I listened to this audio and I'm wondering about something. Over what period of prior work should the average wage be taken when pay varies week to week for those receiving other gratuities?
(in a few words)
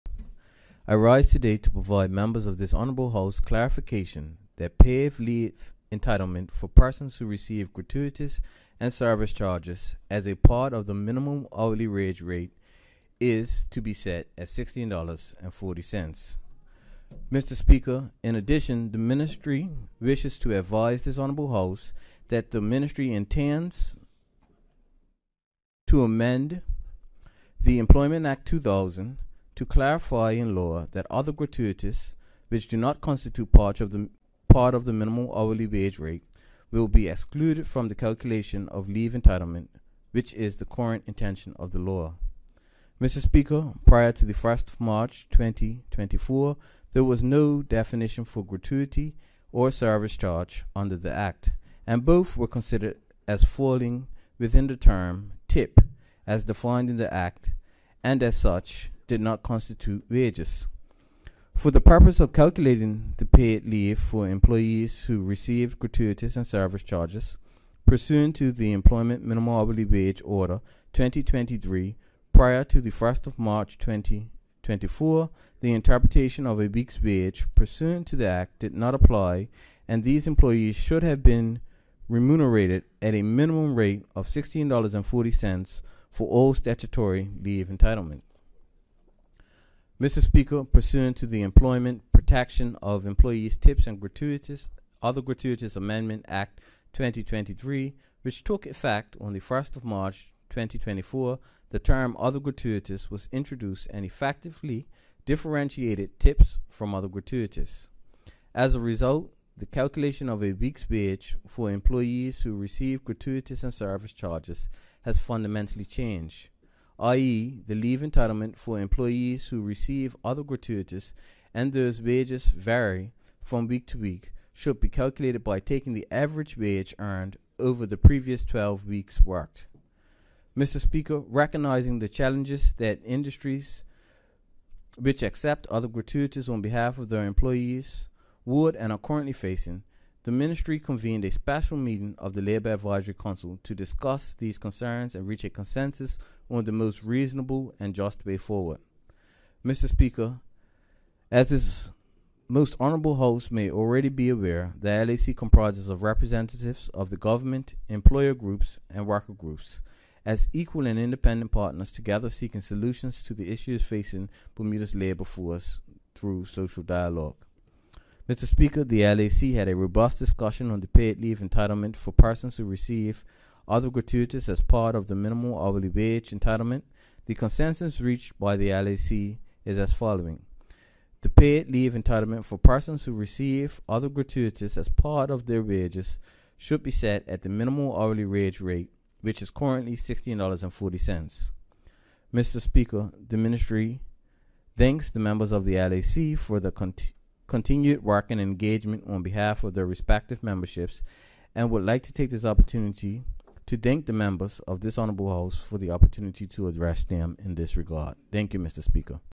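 12 weeks.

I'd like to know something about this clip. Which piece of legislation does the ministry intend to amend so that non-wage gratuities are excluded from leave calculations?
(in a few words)
Employment Act 2000.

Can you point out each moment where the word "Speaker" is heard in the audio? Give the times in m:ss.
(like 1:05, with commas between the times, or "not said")
0:17, 0:43, 1:30, 2:10, 2:29, 2:48, 3:12, 3:28.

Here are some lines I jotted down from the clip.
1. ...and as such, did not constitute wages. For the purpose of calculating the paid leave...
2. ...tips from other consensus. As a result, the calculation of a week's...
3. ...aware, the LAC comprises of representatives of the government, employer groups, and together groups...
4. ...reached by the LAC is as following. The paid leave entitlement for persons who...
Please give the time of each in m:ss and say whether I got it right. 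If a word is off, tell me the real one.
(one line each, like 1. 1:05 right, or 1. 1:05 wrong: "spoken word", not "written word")
1. 0:58 right
2. 1:46 wrong: "gratuitous", not "consensus"
3. 2:34 wrong: "worker", not "together"
4. 2:57 right.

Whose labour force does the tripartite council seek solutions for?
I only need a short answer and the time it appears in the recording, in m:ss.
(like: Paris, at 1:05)
Bermuda, at 2:44.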